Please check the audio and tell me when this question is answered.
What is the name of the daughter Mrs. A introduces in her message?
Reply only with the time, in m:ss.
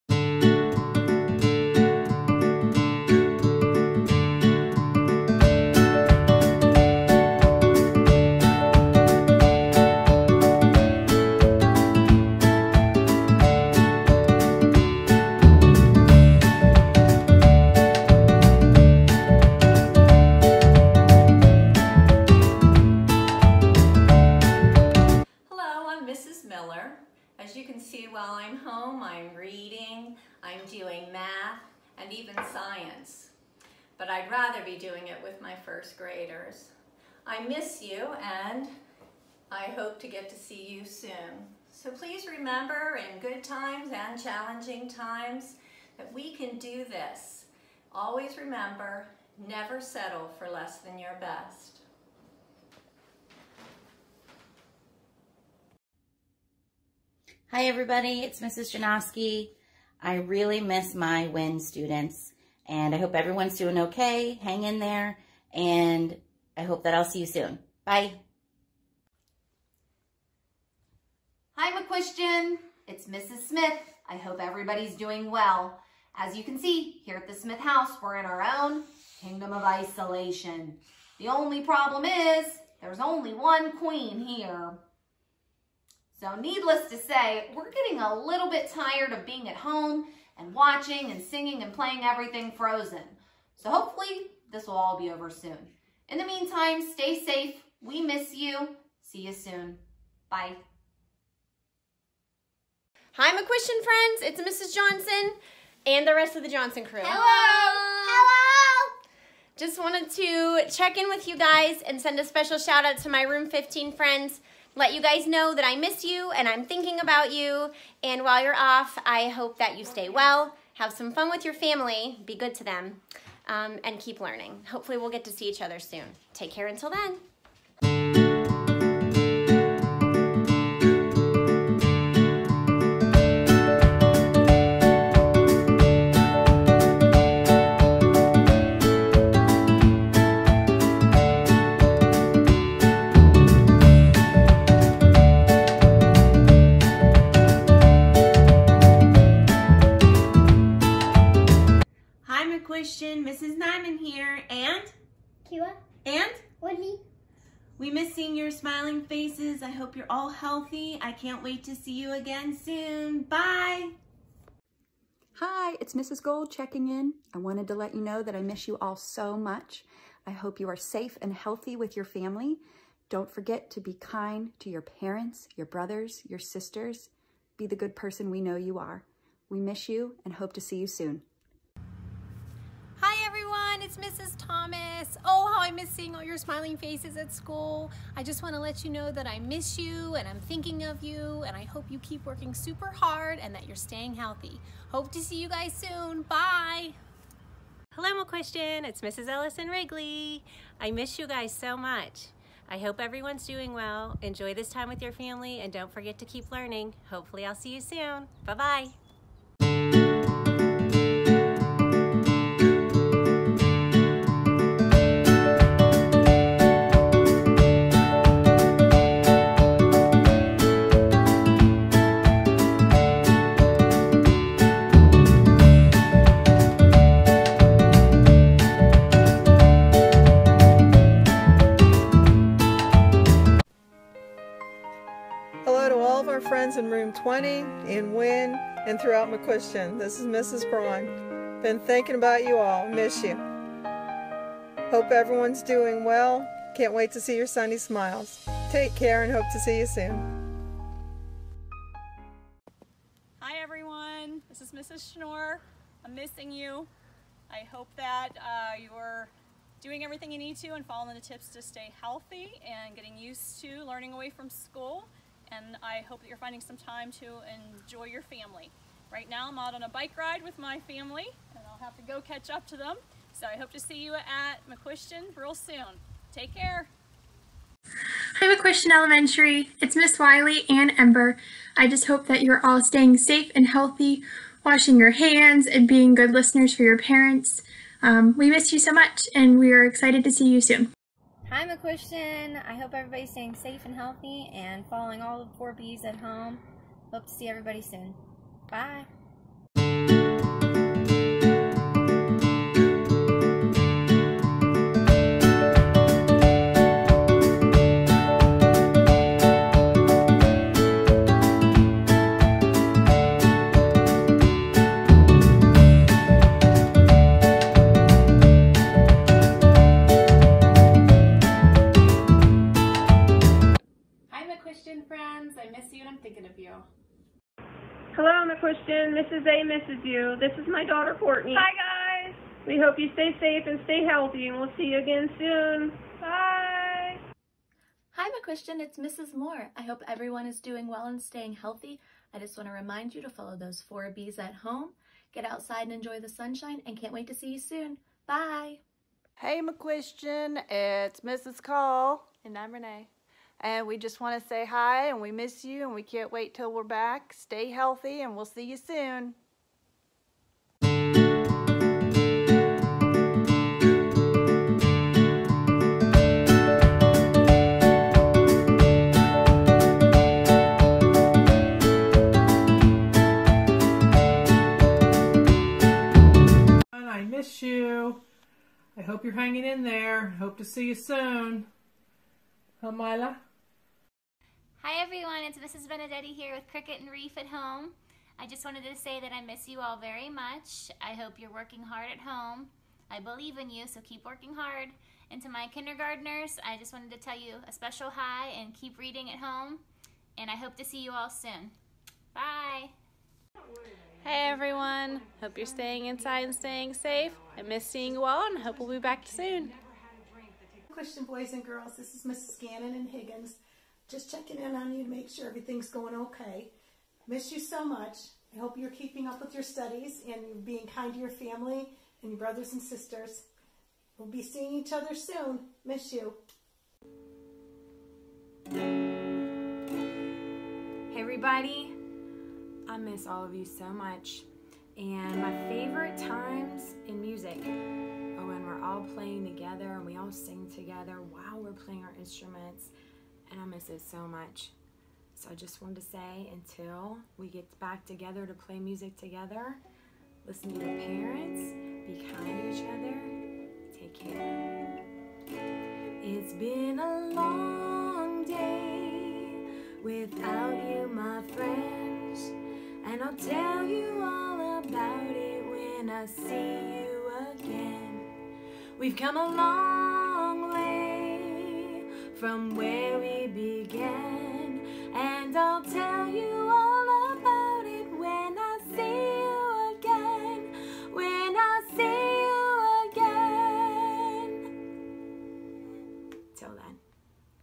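5:31.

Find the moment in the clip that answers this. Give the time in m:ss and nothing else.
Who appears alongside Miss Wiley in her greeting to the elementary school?
4:40.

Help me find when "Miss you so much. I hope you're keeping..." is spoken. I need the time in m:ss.
6:57.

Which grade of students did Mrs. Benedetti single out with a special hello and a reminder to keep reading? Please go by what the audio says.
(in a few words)
kindergartners.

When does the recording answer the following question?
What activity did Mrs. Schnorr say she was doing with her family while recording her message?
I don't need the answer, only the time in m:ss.
4:29.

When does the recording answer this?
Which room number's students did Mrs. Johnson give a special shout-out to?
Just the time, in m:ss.
1:53.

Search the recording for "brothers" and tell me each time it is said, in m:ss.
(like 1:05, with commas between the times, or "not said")
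2:55, 7:02.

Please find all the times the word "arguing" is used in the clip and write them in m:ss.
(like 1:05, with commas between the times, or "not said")
not said.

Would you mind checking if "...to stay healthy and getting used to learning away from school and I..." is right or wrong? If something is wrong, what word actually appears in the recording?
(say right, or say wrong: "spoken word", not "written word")
right.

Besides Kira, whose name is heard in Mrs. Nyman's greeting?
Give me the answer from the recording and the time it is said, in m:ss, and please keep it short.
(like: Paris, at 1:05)
Woody, at 2:36.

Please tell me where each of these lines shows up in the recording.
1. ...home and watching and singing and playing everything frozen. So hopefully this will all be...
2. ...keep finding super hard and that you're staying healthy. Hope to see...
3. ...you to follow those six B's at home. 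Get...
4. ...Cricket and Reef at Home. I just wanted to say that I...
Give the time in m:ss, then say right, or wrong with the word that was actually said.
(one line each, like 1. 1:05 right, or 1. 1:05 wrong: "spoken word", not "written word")
1. 1:29 right
2. 3:11 wrong: "working", not "finding"
3. 5:43 wrong: "four", not "six"
4. 6:26 right.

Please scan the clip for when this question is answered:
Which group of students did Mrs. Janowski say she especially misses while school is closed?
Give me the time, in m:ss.
1:01.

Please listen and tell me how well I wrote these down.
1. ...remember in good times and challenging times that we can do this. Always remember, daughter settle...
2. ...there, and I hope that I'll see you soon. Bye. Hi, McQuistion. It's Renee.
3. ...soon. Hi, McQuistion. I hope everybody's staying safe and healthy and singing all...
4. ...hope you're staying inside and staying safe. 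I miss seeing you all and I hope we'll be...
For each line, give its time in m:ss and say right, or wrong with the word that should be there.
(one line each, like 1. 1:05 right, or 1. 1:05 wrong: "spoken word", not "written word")
1. 0:42 wrong: "never", not "daughter"
2. 1:04 wrong: "Mrs", not "Renee"
3. 4:50 wrong: "following", not "singing"
4. 6:45 right.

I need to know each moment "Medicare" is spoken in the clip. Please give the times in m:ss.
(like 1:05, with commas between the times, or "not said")
not said.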